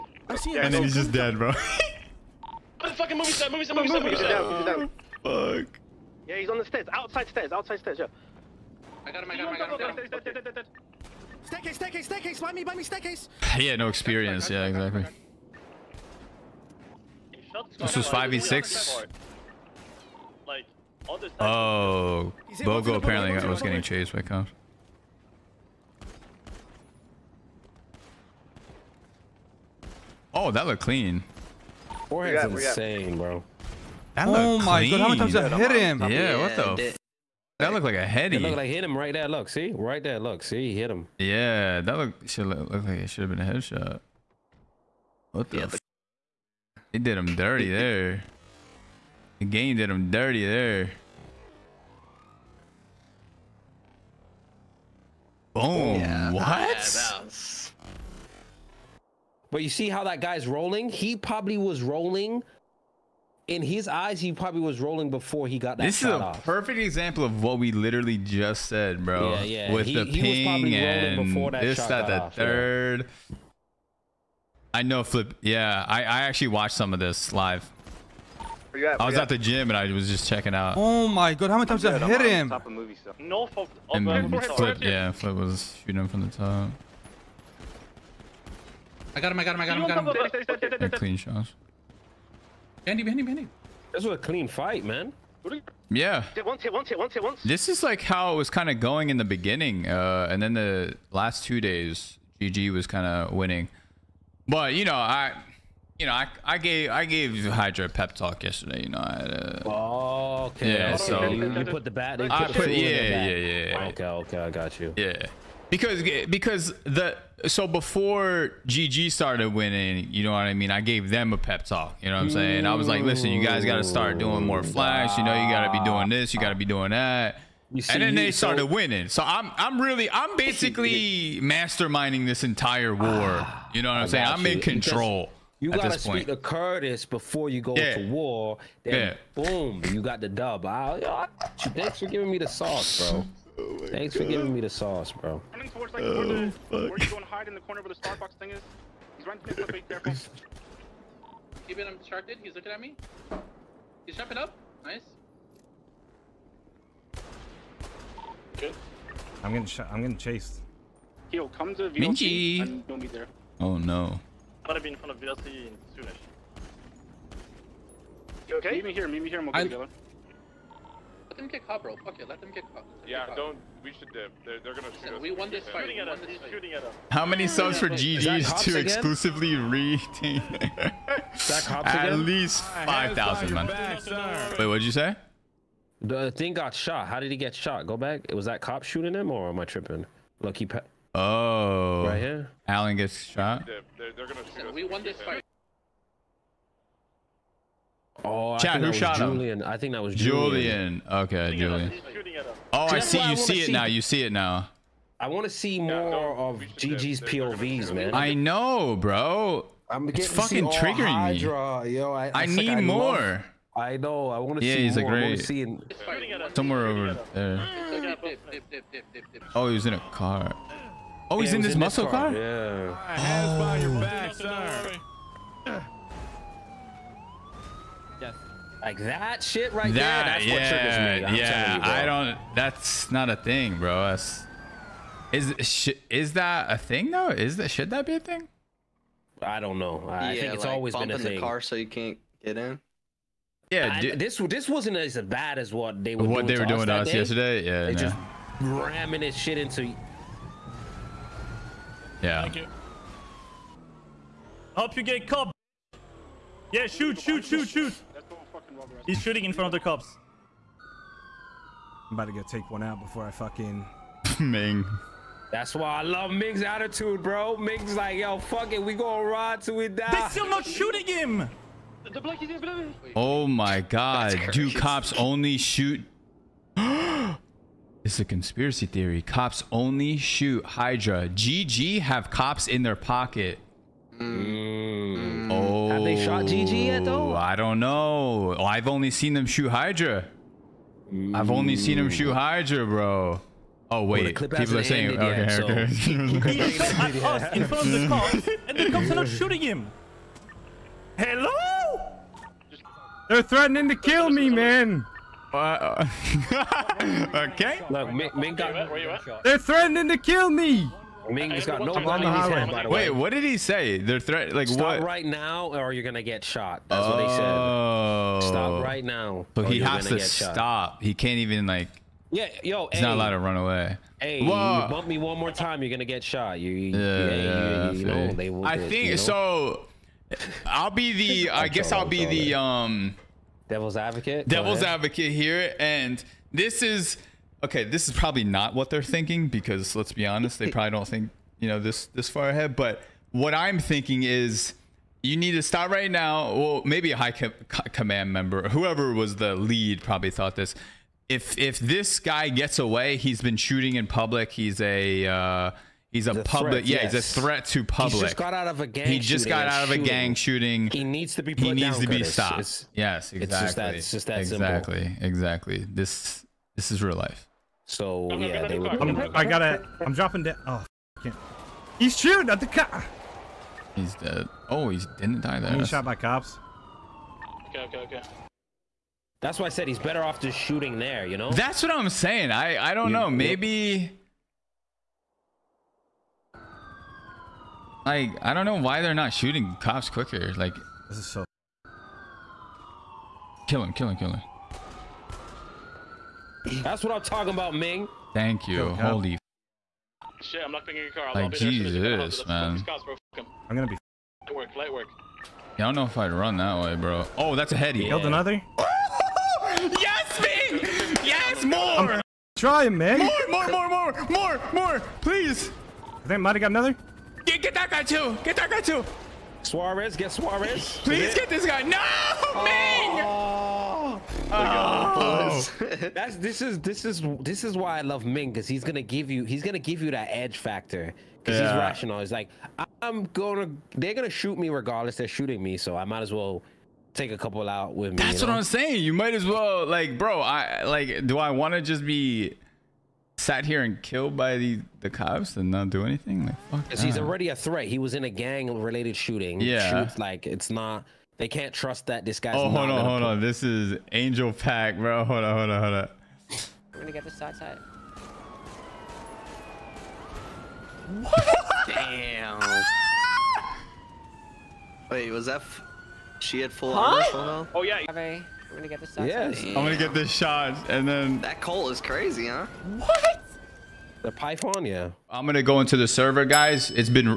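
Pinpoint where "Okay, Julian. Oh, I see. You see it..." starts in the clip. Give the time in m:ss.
3:21.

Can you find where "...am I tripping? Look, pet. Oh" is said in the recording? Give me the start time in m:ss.
3:09.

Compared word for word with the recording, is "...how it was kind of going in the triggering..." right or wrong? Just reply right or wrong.
wrong.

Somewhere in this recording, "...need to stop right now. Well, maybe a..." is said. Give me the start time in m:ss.
5:45.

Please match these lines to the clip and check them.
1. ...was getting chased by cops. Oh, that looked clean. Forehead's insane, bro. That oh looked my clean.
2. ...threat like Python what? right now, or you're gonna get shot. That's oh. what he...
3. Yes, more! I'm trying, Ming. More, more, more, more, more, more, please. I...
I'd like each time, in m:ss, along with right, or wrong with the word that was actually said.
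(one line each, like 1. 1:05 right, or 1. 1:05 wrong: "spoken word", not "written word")
1. 0:23 right
2. 5:14 wrong: "Stop", not "Python"
3. 6:51 right.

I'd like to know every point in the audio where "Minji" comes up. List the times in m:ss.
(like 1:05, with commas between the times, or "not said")
2:42.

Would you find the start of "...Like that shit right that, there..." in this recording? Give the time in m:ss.
3:48.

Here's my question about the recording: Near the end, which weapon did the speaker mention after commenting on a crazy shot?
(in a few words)
Python.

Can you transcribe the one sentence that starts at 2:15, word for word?
Because you gotta speak to Curtis before you go yeah.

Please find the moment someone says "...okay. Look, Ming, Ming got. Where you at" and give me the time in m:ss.
5:07.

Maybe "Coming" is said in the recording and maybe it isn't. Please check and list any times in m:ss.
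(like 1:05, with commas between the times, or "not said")
2:25.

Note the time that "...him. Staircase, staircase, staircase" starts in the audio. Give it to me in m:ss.
0:10.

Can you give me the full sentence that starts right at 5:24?
Hey, you bump me one more time, you're gonna get shot.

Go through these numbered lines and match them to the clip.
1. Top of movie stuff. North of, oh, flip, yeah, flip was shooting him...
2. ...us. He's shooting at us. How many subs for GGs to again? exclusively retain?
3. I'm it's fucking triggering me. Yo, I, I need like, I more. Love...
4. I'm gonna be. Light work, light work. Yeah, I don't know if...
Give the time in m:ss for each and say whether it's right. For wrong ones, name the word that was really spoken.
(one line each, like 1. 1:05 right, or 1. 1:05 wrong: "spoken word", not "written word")
1. 1:22 right
2. 2:56 right
3. 3:29 right
4. 6:43 right.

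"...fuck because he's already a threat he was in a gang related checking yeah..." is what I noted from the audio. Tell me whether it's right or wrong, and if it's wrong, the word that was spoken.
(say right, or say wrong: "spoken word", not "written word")
wrong: "shooting", not "checking".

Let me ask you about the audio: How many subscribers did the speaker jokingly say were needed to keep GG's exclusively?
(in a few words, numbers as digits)
5,000.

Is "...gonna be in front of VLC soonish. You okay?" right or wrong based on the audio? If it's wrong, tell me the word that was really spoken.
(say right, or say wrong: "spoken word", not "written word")
right.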